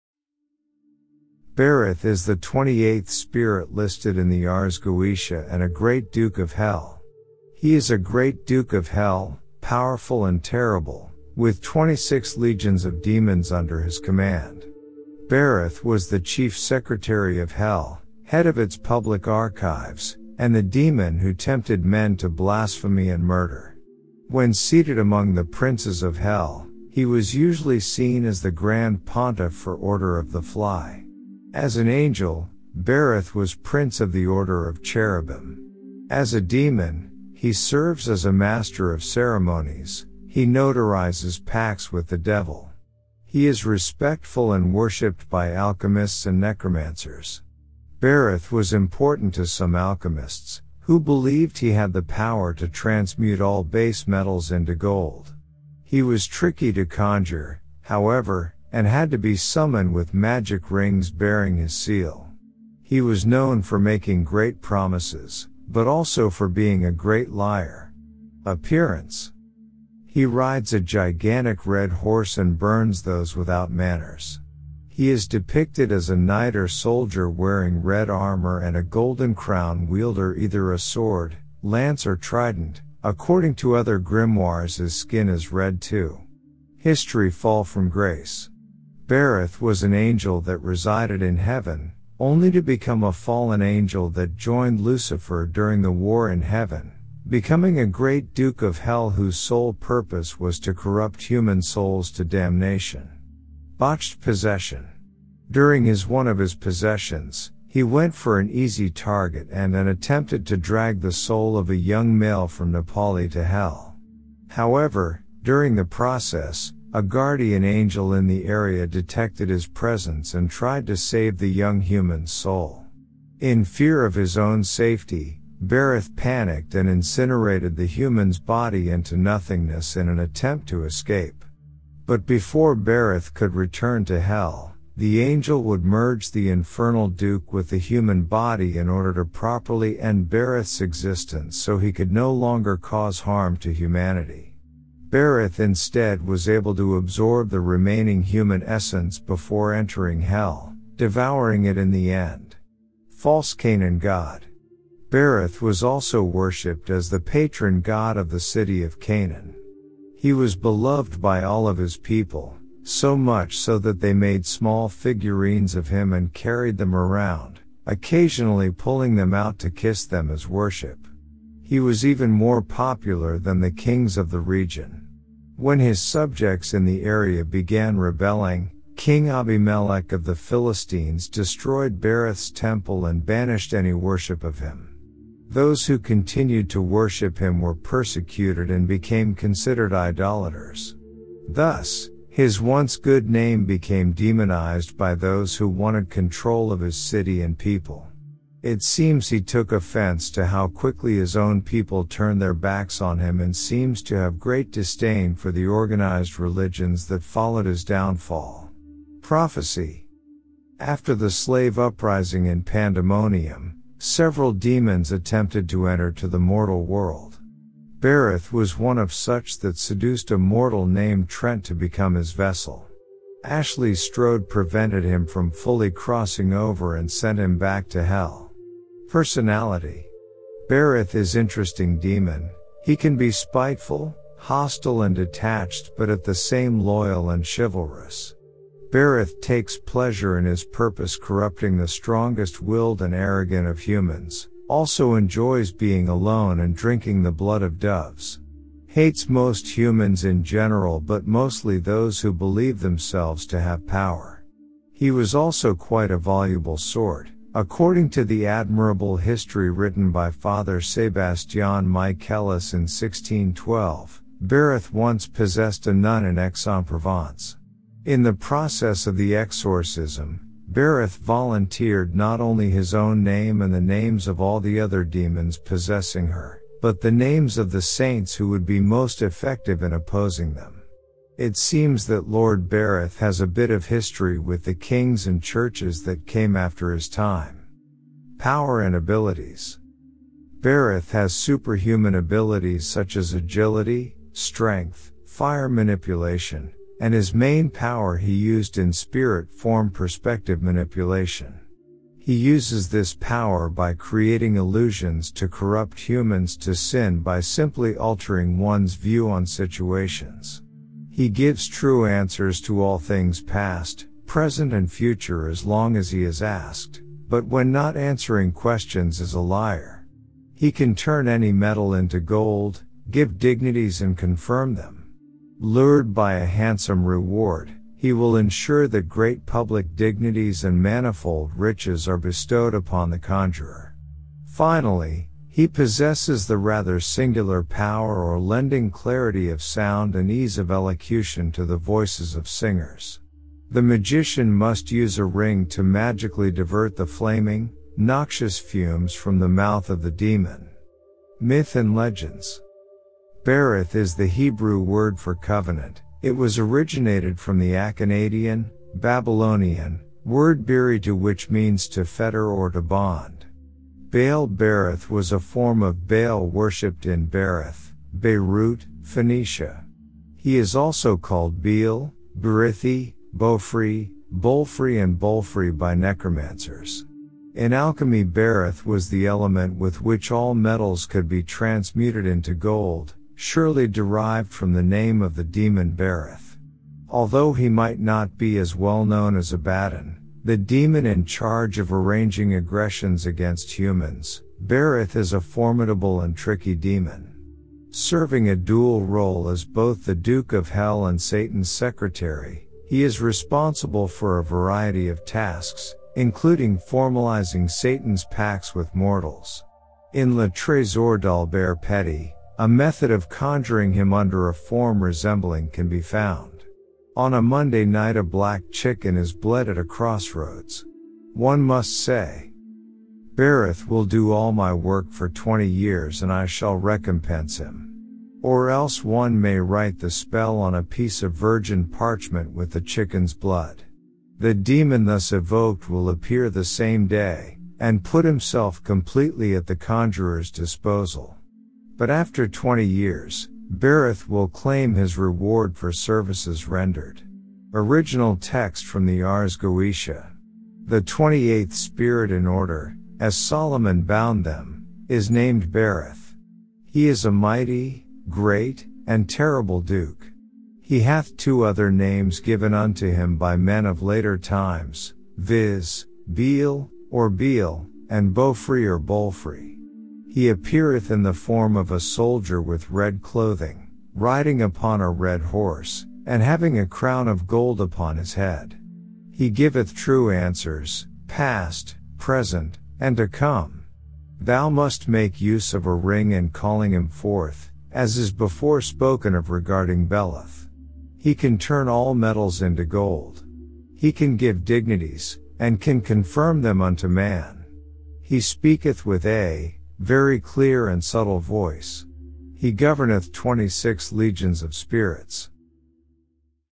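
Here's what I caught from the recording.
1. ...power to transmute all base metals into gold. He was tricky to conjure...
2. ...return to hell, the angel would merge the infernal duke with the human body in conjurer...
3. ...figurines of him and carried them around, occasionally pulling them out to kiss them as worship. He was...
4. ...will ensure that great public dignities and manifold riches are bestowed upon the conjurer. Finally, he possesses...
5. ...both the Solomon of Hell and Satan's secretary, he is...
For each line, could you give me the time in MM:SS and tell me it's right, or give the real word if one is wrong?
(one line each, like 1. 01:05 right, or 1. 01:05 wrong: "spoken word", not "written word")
1. 00:52 right
2. 02:13 wrong: "order", not "conjurer"
3. 02:44 right
4. 05:28 right
5. 06:39 wrong: "Duke", not "Solomon".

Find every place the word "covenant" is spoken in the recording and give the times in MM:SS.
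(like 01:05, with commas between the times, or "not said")
05:55.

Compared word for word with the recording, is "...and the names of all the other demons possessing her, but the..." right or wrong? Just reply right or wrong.
right.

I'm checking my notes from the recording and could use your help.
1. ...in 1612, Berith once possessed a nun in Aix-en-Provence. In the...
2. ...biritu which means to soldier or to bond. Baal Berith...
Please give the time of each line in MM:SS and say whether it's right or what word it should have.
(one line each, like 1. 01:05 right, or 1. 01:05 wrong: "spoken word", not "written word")
1. 04:22 right
2. 06:00 wrong: "fetter", not "soldier".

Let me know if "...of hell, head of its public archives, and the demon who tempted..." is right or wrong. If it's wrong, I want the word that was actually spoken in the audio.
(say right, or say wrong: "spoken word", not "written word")
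right.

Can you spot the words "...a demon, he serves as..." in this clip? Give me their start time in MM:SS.
00:36.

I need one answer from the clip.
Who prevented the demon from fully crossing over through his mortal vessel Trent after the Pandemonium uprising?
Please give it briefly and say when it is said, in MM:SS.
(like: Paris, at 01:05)
Ashley Strode, at 03:43.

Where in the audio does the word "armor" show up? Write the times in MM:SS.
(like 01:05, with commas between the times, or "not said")
01:18.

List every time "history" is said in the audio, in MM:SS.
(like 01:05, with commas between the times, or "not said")
01:26, 04:19, 04:43.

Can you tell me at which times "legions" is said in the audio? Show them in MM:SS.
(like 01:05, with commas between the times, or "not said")
00:12, 08:24.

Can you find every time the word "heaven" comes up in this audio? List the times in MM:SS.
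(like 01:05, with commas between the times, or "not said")
01:31, 01:36.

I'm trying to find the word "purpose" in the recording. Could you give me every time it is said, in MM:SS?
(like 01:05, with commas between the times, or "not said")
01:39, 04:00.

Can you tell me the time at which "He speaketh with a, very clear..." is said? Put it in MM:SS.
08:18.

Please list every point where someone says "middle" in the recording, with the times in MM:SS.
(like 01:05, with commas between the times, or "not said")
not said.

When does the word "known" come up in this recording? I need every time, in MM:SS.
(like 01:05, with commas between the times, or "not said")
01:03, 06:29.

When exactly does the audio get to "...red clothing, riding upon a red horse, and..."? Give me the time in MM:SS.
07:52.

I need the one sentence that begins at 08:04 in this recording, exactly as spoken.
Thou must make use of a ring in calling him forth, as is before spoken of regarding Beleth.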